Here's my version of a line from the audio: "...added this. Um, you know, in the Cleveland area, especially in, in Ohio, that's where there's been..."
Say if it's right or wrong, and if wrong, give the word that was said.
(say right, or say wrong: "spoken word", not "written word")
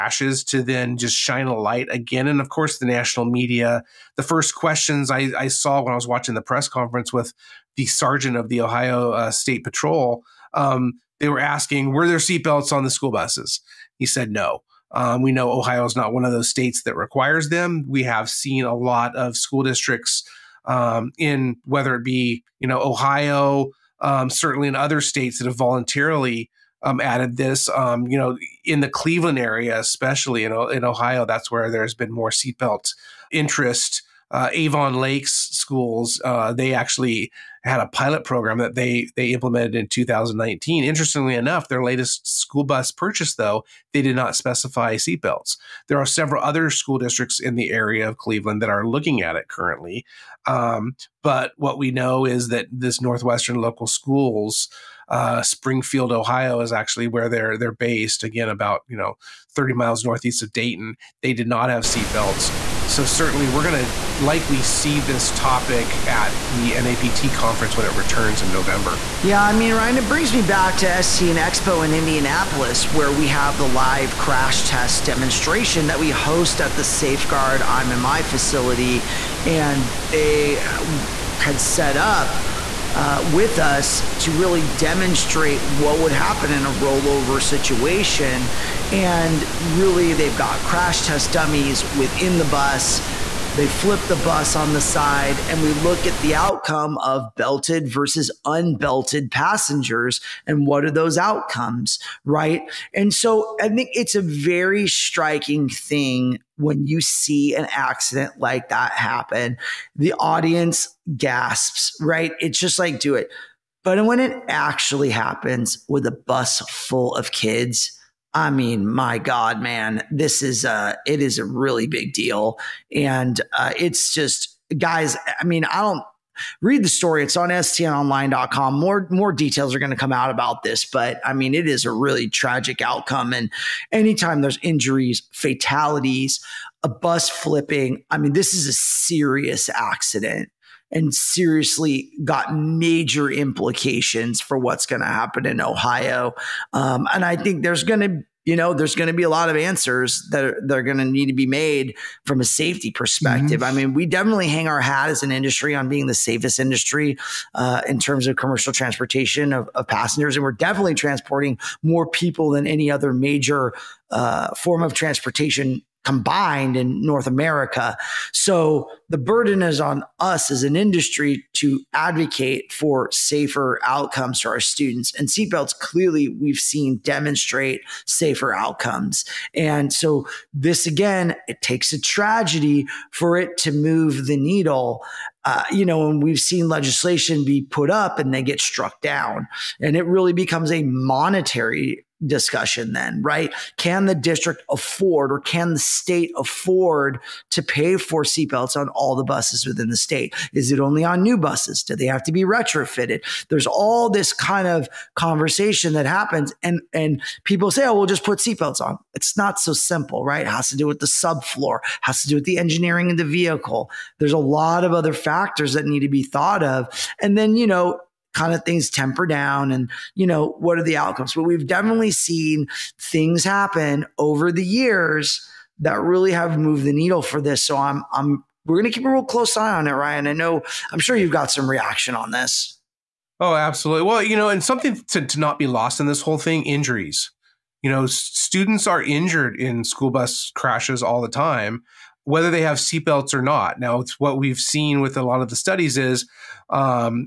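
right.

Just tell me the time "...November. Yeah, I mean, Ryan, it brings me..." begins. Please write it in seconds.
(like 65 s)
68 s.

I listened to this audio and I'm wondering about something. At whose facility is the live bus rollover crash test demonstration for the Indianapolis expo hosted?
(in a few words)
Safeguard IMMI.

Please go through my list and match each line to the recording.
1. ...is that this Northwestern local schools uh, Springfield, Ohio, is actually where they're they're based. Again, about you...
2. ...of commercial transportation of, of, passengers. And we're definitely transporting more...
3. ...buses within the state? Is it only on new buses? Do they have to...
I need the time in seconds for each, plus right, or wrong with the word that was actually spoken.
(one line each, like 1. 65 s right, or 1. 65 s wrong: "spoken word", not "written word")
1. 52 s right
2. 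158 s right
3. 199 s right.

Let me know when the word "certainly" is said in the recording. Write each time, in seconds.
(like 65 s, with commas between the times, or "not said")
24 s, 63 s.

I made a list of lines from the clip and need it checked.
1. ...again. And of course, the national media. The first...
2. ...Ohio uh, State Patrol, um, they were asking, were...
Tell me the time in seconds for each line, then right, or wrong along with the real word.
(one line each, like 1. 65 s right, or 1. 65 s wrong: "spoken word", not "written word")
1. 1 s right
2. 8 s right.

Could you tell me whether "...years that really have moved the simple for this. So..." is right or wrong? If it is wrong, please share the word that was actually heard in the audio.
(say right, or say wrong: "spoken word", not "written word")
wrong: "needle", not "simple".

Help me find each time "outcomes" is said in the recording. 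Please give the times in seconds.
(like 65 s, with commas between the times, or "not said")
96 s, 101 s, 132 s, 173 s, 178 s, 220 s.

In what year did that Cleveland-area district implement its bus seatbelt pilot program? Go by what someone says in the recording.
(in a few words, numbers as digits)
2019.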